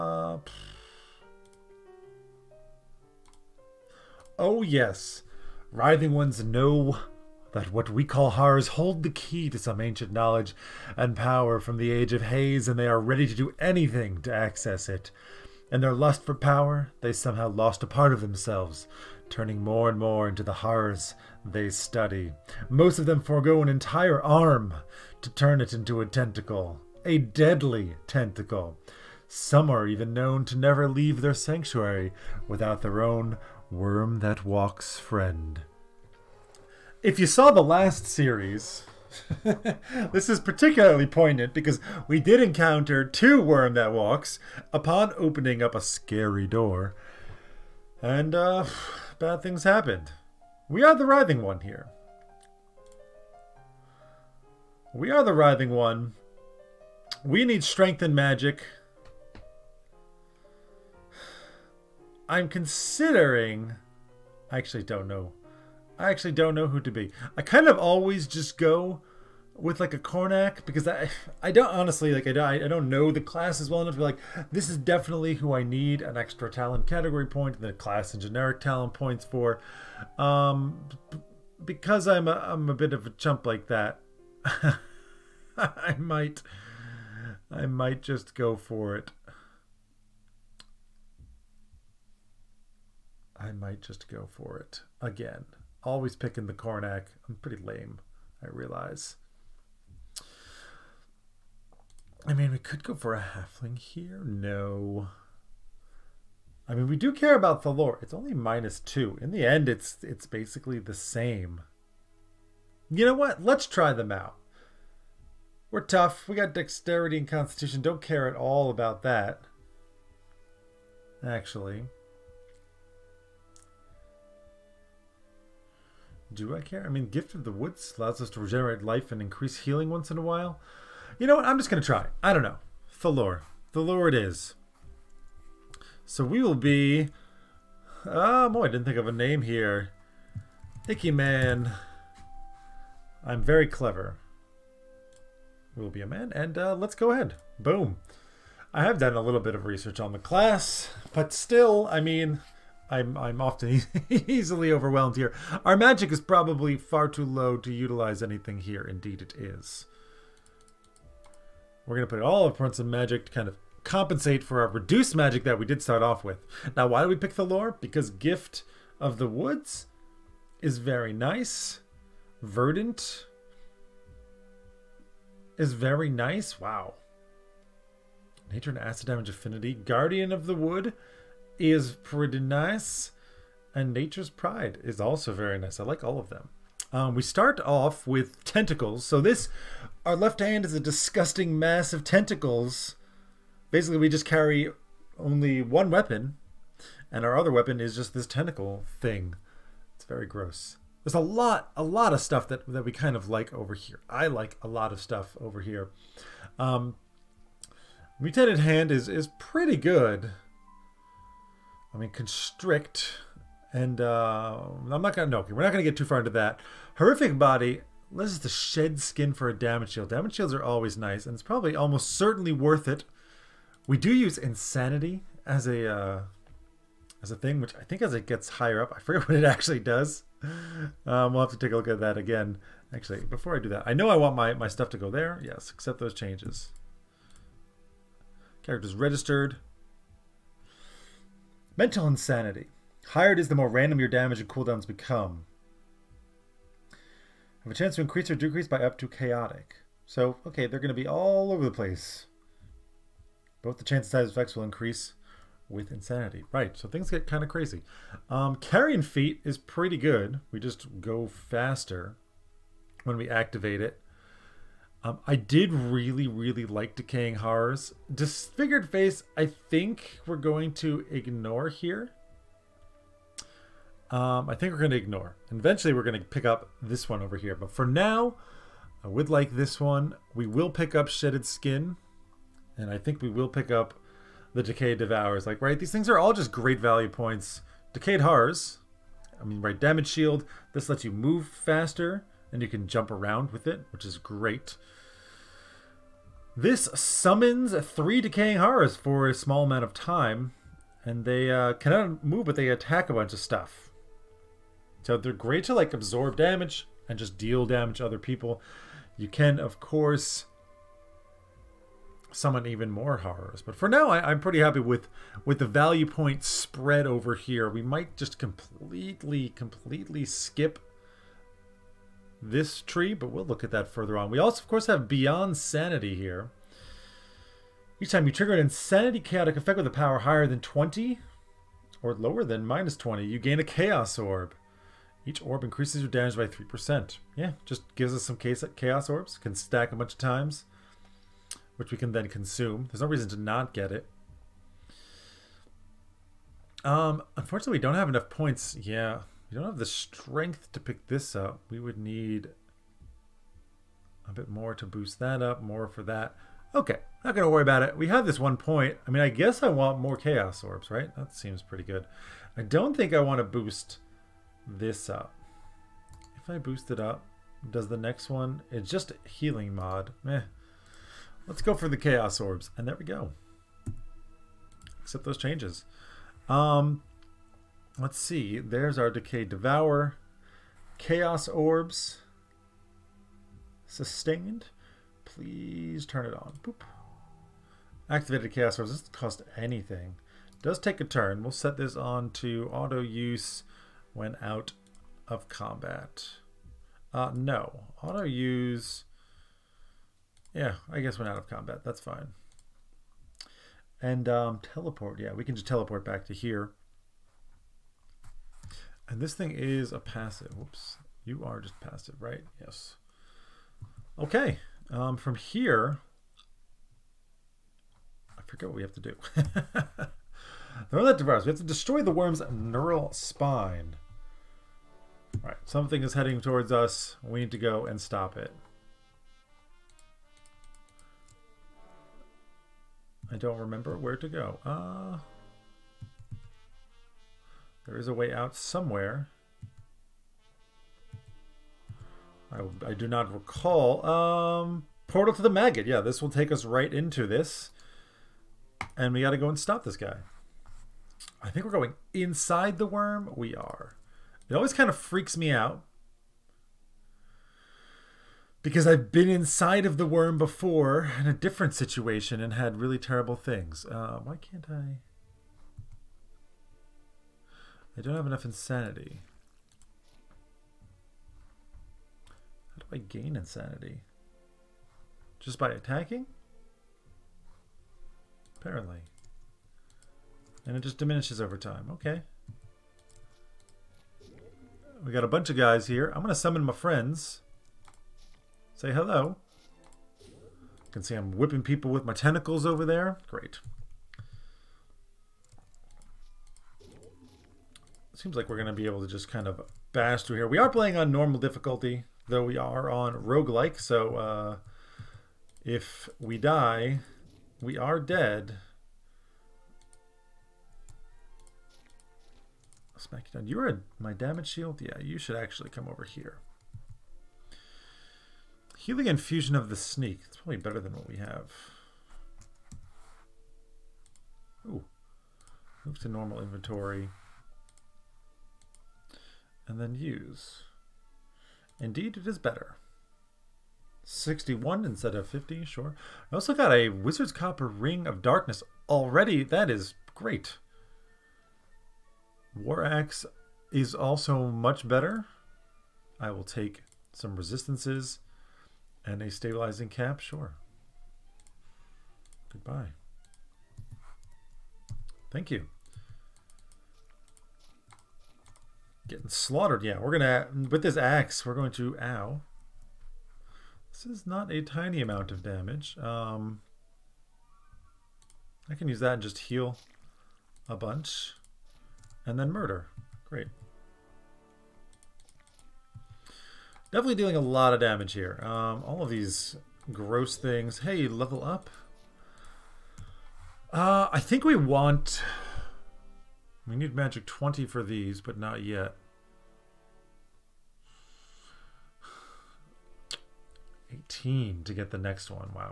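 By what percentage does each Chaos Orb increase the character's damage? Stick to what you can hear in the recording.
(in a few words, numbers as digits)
3%.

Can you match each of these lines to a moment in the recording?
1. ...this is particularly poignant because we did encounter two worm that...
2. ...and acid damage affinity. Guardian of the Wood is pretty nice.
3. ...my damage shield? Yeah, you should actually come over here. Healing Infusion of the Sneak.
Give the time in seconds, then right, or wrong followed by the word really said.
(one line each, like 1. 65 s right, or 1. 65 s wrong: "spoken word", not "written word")
1. 40 s right
2. 178 s right
3. 513 s right.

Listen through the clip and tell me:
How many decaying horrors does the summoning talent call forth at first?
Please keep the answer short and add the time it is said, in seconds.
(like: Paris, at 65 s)
3, at 297 s.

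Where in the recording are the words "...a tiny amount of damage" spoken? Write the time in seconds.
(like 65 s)
564 s.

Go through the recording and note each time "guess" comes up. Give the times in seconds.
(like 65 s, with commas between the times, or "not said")
359 s, 400 s.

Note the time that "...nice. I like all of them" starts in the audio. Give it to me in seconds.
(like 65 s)
185 s.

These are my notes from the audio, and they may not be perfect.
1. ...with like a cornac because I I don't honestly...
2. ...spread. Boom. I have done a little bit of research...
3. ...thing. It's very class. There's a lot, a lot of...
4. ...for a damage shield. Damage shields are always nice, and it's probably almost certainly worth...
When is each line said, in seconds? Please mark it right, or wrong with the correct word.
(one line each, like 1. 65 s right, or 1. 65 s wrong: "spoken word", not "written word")
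1. 69 s right
2. 147 s wrong: "ahead", not "spread"
3. 198 s wrong: "gross", not "class"
4. 219 s right.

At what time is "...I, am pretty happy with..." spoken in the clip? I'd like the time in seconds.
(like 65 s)
314 s.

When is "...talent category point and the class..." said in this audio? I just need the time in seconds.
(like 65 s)
76 s.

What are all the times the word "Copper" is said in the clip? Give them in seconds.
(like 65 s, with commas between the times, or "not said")
537 s.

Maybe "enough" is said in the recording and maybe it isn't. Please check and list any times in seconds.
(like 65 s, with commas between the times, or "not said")
73 s, 348 s, 468 s.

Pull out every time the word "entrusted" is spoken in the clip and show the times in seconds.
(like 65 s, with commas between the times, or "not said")
not said.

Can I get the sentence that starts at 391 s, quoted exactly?
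We'll set this on to auto use when out of combat.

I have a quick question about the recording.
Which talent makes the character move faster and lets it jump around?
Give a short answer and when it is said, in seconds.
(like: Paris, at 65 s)
Carrion Feet, at 258 s.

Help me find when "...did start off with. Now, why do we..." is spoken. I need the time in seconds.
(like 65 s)
165 s.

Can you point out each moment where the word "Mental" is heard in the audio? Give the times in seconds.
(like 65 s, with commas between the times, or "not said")
241 s.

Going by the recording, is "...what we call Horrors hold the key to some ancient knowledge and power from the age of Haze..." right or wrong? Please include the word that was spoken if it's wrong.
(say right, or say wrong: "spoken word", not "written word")
right.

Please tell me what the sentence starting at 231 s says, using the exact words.
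Um, we'll have to take a look at that again.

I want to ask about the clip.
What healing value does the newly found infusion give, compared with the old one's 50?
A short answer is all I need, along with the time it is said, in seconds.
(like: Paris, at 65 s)
61, at 534 s.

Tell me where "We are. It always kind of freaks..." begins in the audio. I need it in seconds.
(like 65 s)
453 s.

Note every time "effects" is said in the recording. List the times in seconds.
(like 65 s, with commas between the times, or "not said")
254 s, 329 s.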